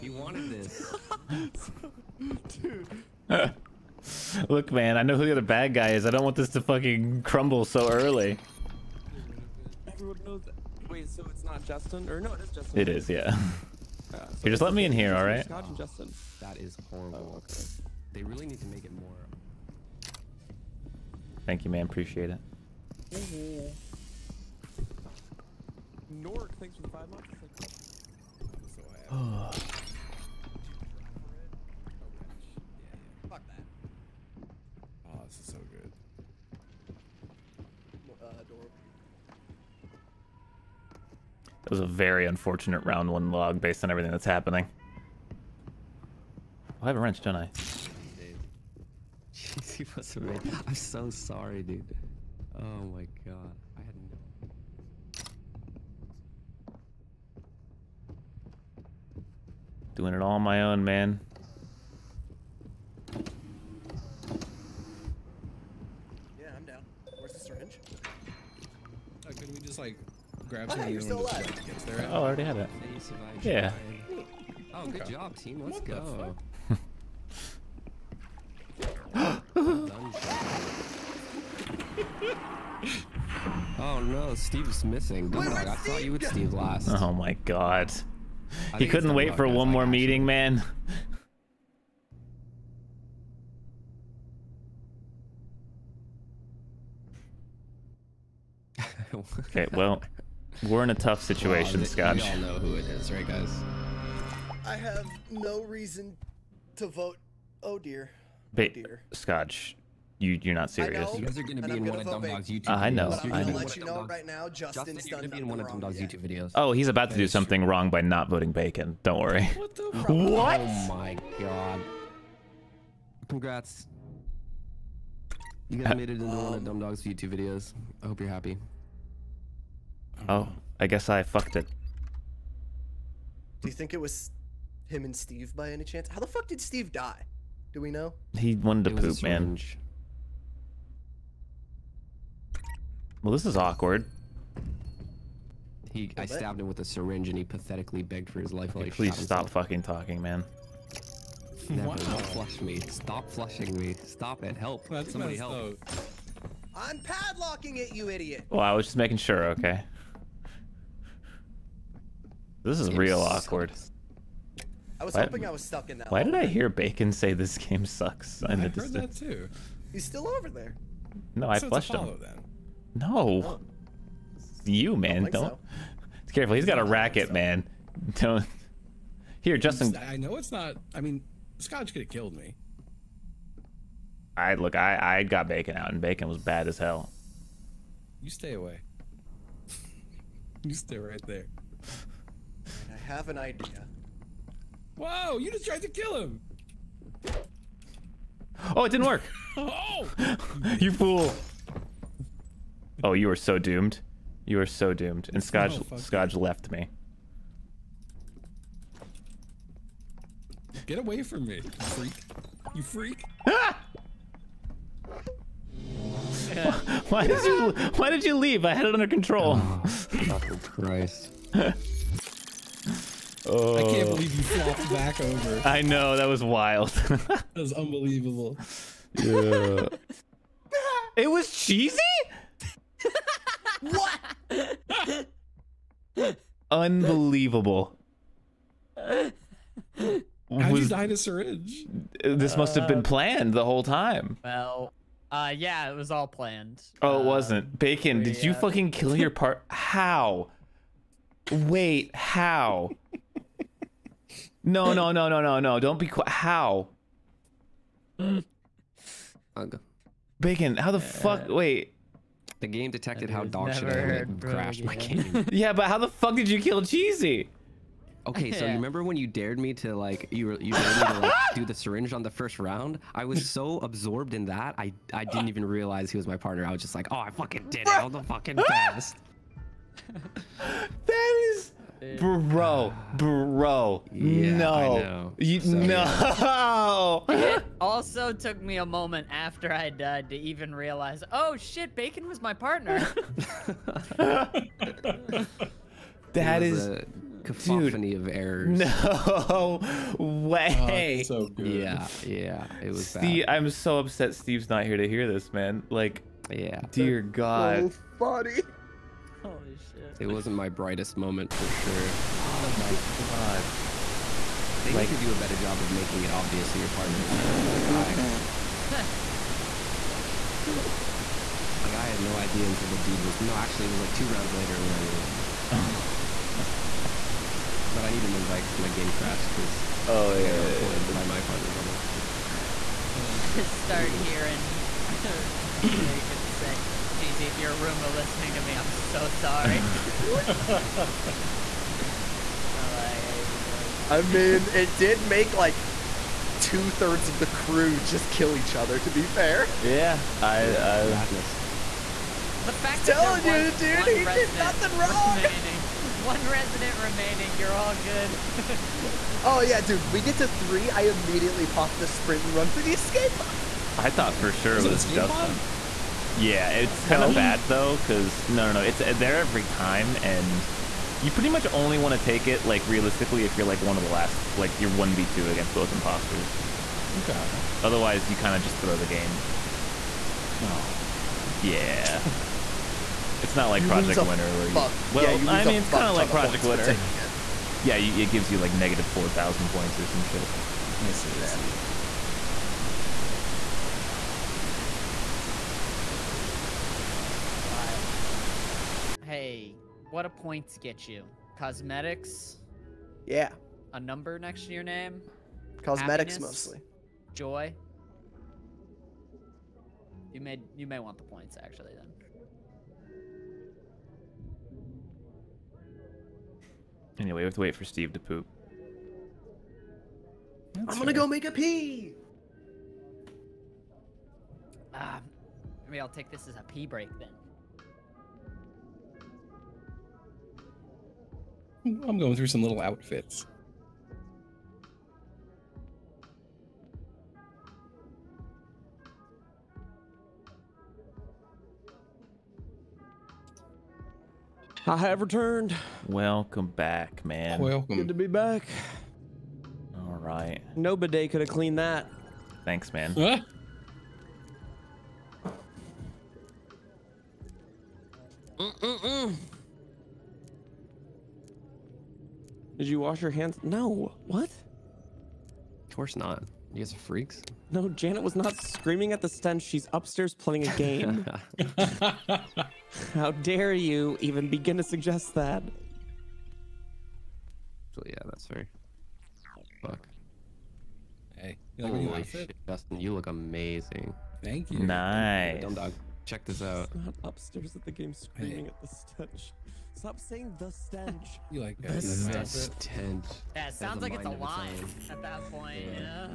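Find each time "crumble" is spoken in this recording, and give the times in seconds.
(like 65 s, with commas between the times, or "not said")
7 s.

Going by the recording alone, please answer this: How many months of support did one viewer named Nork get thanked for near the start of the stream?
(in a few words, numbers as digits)
5.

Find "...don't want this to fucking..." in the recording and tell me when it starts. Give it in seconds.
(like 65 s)
6 s.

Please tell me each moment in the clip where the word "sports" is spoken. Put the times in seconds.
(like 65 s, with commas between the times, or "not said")
not said.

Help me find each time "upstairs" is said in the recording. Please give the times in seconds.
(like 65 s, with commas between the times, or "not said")
469 s, 487 s.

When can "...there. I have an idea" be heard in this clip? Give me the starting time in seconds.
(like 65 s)
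191 s.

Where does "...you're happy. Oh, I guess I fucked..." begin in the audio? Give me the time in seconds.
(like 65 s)
128 s.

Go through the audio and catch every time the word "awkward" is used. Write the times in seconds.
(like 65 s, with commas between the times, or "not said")
143 s, 163 s.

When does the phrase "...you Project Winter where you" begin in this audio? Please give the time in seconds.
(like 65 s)
383 s.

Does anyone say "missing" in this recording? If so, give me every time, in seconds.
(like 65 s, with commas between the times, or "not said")
84 s.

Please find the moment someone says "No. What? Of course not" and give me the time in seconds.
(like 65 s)
463 s.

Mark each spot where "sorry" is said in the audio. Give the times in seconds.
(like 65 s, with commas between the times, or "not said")
51 s, 339 s.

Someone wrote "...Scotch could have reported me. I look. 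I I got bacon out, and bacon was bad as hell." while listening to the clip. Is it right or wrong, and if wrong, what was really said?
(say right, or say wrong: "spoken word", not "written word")
wrong: "killed", not "reported".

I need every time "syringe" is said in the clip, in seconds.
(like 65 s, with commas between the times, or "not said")
67 s, 146 s, 241 s, 271 s.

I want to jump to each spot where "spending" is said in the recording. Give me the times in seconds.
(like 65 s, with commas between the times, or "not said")
not said.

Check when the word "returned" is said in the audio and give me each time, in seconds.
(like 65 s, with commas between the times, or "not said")
445 s.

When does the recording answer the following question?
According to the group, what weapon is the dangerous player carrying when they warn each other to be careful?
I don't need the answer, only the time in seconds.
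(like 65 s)
176 s.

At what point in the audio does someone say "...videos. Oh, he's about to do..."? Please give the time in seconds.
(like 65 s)
116 s.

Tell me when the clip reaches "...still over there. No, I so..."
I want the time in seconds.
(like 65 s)
170 s.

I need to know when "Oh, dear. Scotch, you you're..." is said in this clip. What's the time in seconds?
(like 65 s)
108 s.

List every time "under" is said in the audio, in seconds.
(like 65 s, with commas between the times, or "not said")
218 s.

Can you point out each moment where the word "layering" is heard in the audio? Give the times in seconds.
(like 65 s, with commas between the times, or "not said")
not said.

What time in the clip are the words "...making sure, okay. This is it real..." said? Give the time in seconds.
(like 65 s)
158 s.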